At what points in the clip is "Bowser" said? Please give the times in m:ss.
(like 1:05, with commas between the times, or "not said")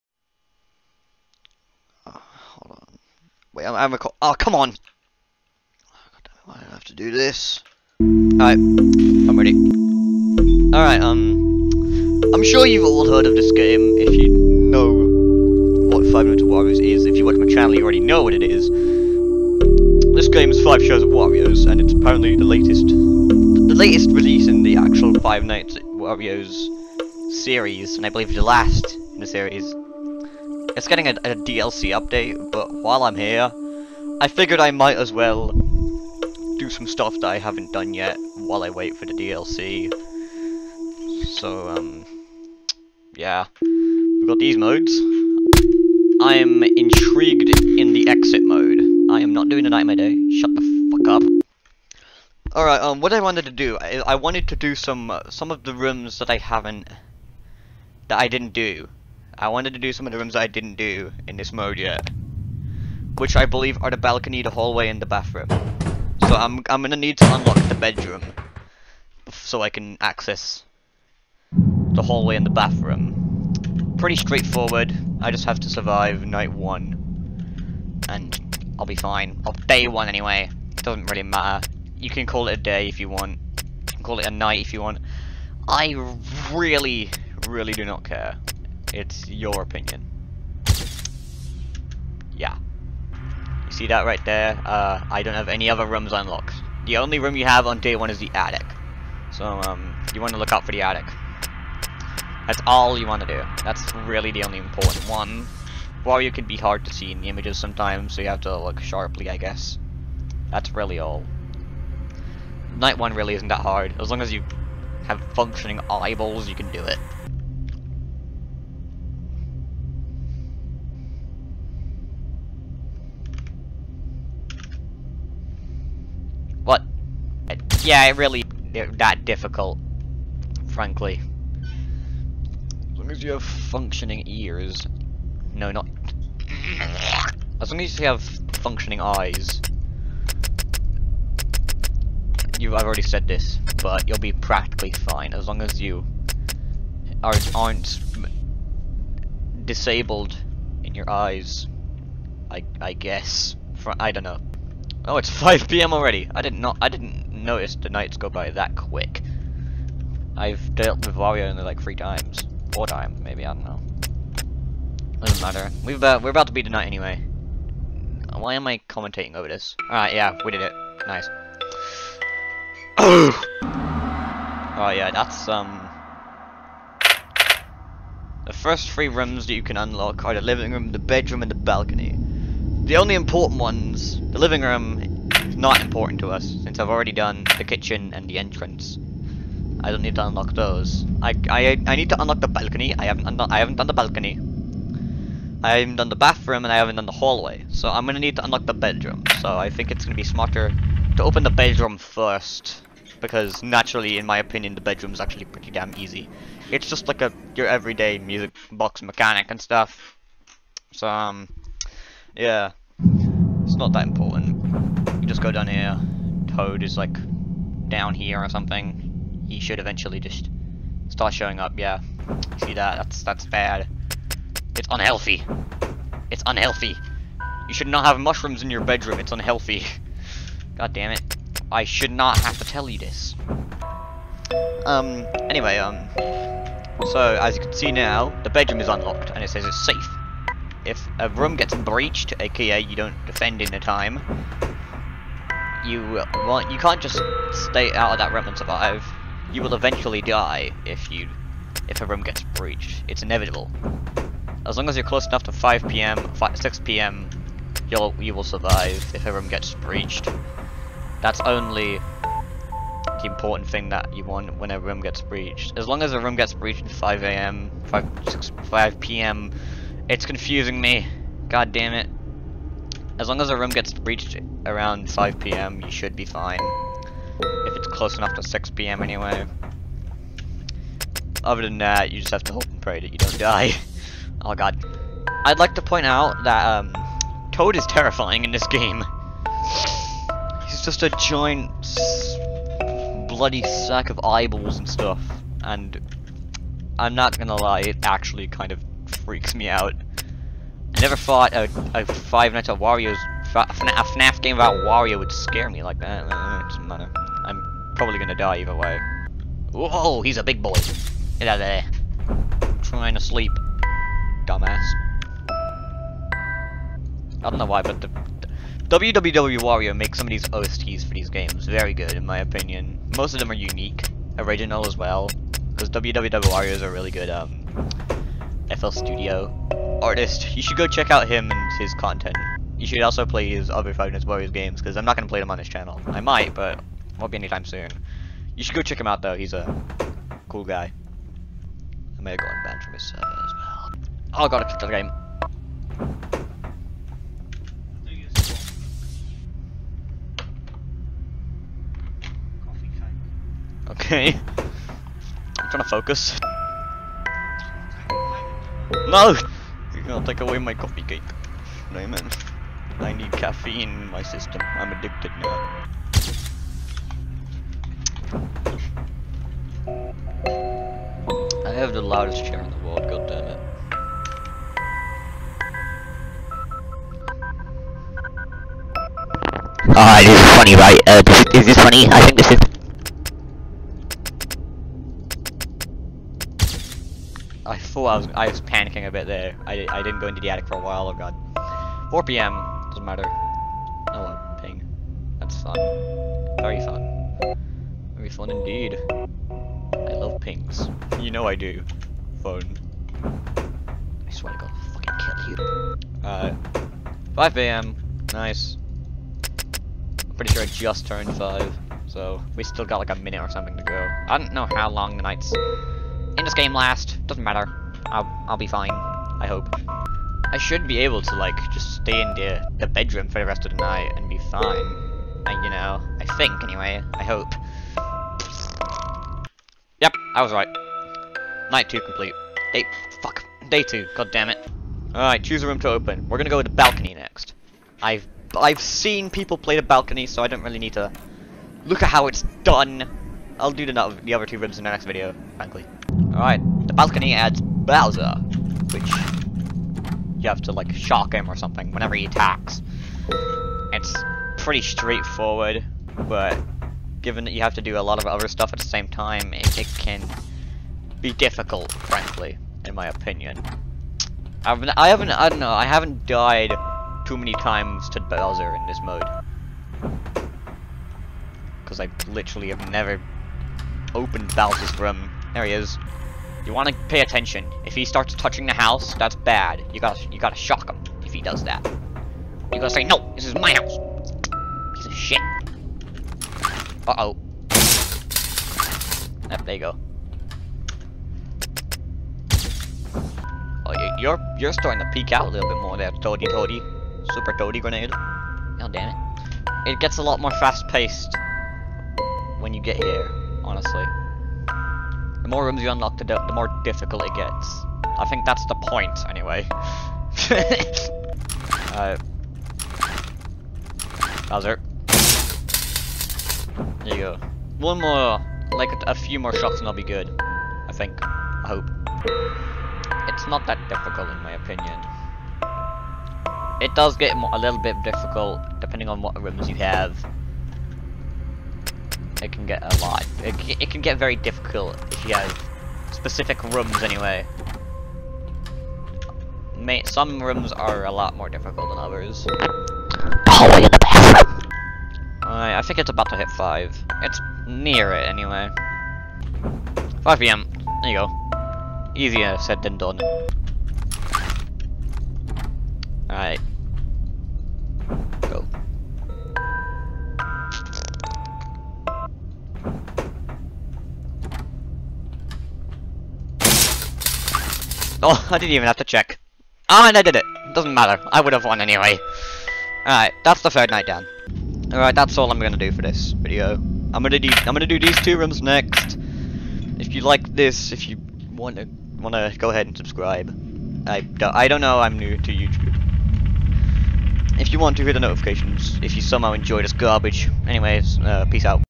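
7:27, 7:48, 7:54, 8:34.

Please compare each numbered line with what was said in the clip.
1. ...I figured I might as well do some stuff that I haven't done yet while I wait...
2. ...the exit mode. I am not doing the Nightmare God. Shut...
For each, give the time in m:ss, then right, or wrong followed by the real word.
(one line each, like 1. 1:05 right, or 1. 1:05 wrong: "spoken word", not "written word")
1. 0:34 right
2. 0:47 wrong: "Day", not "God".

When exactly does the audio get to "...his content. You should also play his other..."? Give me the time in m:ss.
5:31.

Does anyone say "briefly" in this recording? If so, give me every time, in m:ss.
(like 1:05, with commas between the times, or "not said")
not said.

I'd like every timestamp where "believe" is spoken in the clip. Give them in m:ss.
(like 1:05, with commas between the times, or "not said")
0:28, 1:03.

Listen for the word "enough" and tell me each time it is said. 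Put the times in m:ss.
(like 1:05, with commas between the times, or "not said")
4:15, 4:38.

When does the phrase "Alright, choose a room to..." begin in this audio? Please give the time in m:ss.
7:15.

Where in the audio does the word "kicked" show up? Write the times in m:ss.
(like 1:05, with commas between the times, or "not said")
5:44.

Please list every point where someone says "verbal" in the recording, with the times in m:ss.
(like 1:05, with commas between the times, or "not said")
not said.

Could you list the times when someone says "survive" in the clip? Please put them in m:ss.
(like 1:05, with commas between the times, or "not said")
1:15, 4:08, 4:18.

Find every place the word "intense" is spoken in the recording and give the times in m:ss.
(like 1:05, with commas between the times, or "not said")
not said.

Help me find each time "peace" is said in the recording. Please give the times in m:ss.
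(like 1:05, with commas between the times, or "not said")
9:51.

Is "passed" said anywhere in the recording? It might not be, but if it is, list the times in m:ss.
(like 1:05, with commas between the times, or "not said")
not said.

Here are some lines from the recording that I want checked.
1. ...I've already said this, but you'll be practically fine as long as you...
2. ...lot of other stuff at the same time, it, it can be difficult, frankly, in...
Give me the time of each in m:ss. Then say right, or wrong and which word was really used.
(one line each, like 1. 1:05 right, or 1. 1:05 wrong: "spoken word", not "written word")
1. 2:22 right
2. 7:38 right.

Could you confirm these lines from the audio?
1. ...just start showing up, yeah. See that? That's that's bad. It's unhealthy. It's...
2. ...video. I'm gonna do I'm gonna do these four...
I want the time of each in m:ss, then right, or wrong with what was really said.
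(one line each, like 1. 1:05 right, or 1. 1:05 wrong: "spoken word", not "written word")
1. 3:40 right
2. 9:36 wrong: "two", not "four".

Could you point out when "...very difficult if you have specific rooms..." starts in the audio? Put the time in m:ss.
8:54.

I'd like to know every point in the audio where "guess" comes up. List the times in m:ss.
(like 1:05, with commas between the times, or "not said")
1:49, 2:32.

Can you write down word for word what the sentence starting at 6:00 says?
You're gonna take away my coffee cake.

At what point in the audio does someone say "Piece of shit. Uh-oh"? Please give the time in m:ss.
8:04.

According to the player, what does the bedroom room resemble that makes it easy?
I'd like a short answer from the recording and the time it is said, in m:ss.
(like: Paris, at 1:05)
Music box, at 3:28.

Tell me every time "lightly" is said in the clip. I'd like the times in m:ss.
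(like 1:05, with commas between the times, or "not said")
not said.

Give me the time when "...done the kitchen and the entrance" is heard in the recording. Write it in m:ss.
3:07.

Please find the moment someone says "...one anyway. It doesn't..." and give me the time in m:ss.
1:19.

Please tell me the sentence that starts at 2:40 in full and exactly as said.
I've dealt with Wario only like three times.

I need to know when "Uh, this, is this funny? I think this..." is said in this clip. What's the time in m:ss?
6:21.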